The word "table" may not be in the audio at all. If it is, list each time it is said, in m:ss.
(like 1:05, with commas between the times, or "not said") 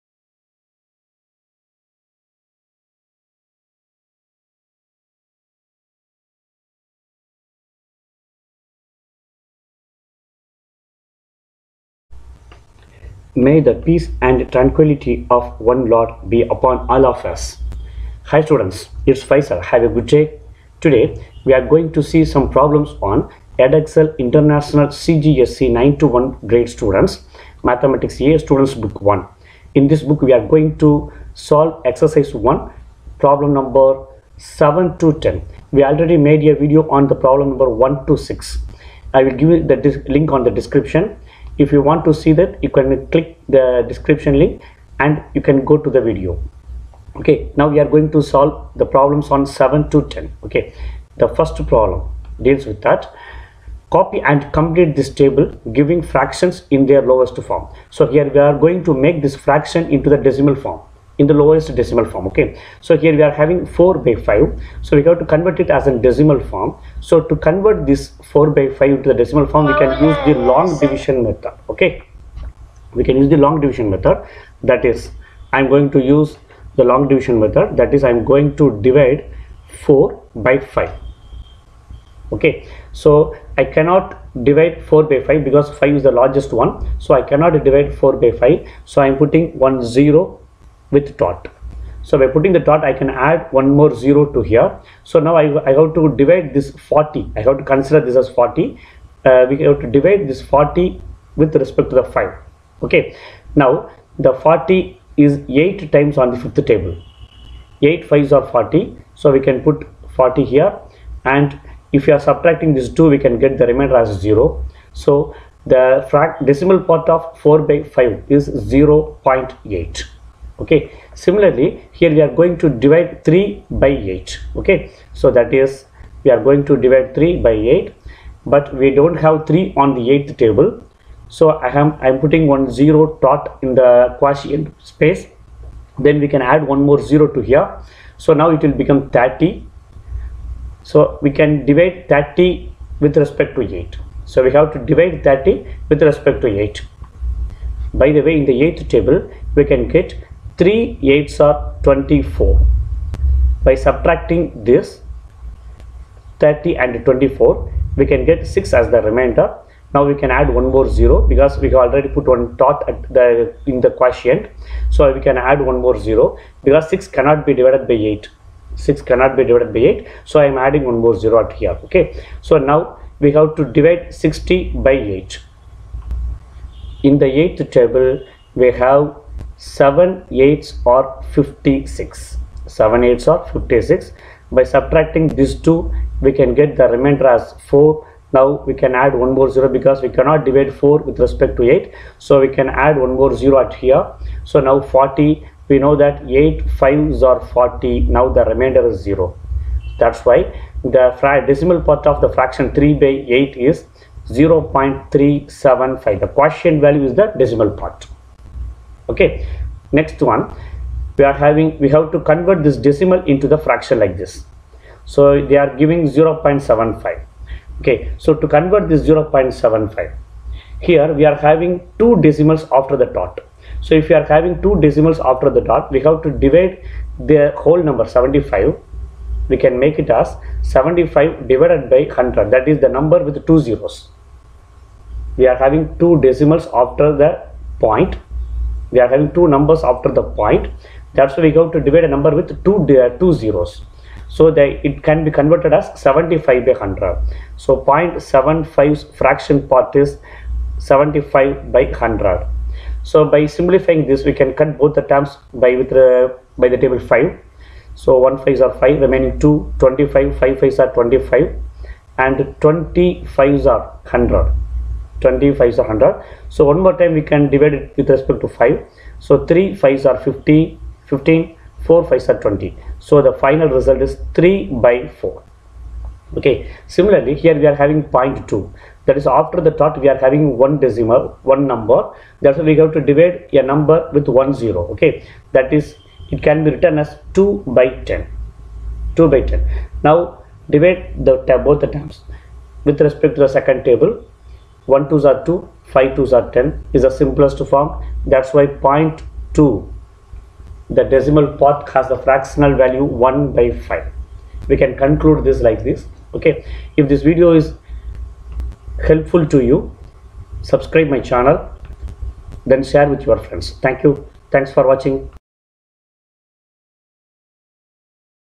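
0:55, 1:46, 2:10, 2:28, 2:57, 4:16, 4:53.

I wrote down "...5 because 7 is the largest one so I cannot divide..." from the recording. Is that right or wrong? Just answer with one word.
wrong.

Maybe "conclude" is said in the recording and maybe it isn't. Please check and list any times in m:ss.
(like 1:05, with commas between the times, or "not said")
5:05.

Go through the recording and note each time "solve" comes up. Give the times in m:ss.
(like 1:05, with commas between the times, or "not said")
0:31, 0:48.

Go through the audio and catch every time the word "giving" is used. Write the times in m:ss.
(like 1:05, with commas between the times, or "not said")
0:55, 3:35.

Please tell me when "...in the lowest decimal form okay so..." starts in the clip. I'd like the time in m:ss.
1:01.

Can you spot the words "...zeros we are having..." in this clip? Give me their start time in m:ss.
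3:53.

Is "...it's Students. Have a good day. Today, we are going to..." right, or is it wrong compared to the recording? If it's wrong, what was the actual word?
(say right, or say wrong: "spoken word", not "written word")
wrong: "Faizal", not "Students".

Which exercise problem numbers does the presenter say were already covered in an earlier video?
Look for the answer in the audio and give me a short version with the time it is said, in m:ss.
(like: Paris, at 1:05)
1 to 6, at 0:37.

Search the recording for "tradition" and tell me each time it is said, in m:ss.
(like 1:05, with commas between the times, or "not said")
not said.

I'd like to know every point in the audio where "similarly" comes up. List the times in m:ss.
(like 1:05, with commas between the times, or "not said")
2:01, 4:36.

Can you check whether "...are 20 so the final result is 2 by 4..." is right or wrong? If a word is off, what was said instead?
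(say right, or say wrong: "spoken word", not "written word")
wrong: "3", not "2".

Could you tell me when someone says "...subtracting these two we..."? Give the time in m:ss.
3:04.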